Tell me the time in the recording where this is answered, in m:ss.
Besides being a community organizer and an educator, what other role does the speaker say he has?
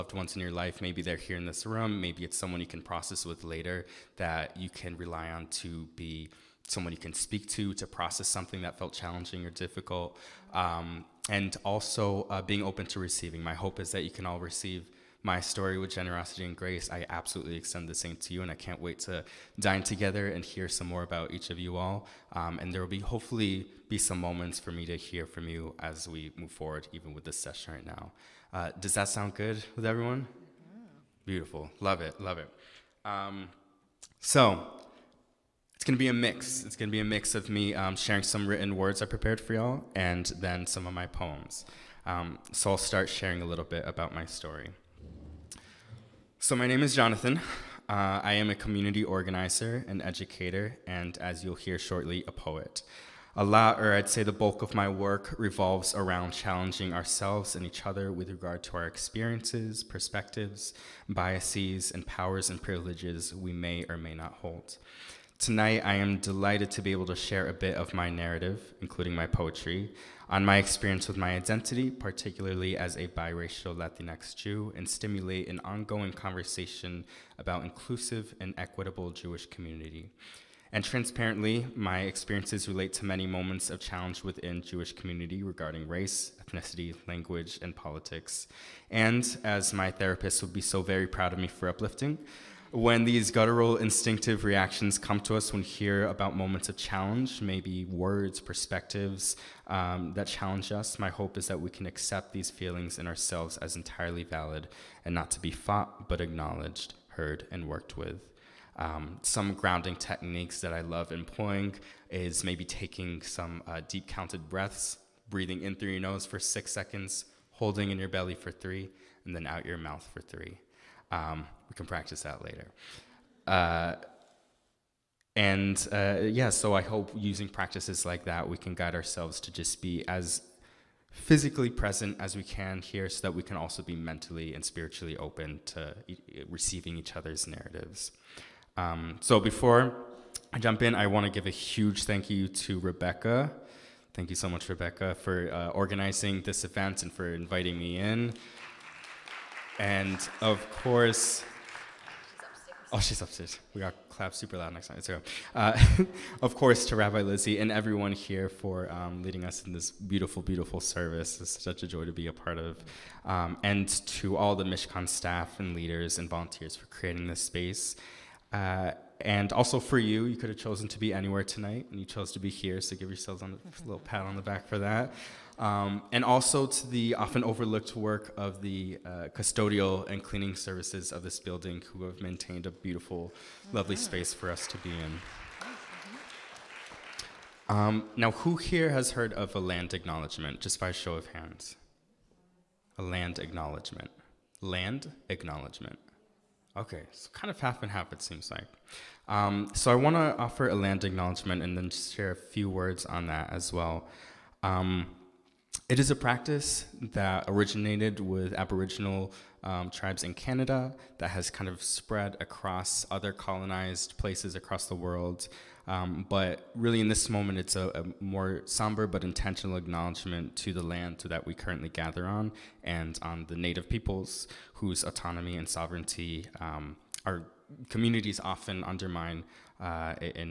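0:52.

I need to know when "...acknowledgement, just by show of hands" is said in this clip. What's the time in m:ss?
3:09.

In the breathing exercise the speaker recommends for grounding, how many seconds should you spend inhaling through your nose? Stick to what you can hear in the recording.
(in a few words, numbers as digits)
6.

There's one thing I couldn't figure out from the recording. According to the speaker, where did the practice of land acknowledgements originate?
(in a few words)
Canada.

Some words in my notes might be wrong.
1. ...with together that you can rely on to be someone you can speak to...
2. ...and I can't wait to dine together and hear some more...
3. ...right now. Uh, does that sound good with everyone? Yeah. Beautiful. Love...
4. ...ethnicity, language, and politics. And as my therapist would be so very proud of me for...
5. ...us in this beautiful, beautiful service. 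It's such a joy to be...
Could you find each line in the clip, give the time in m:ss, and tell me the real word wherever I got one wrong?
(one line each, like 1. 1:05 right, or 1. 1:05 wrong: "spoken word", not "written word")
1. 0:03 wrong: "later", not "together"
2. 0:18 right
3. 0:27 right
4. 1:26 right
5. 2:39 right.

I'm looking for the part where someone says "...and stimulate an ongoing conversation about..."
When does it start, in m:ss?
1:14.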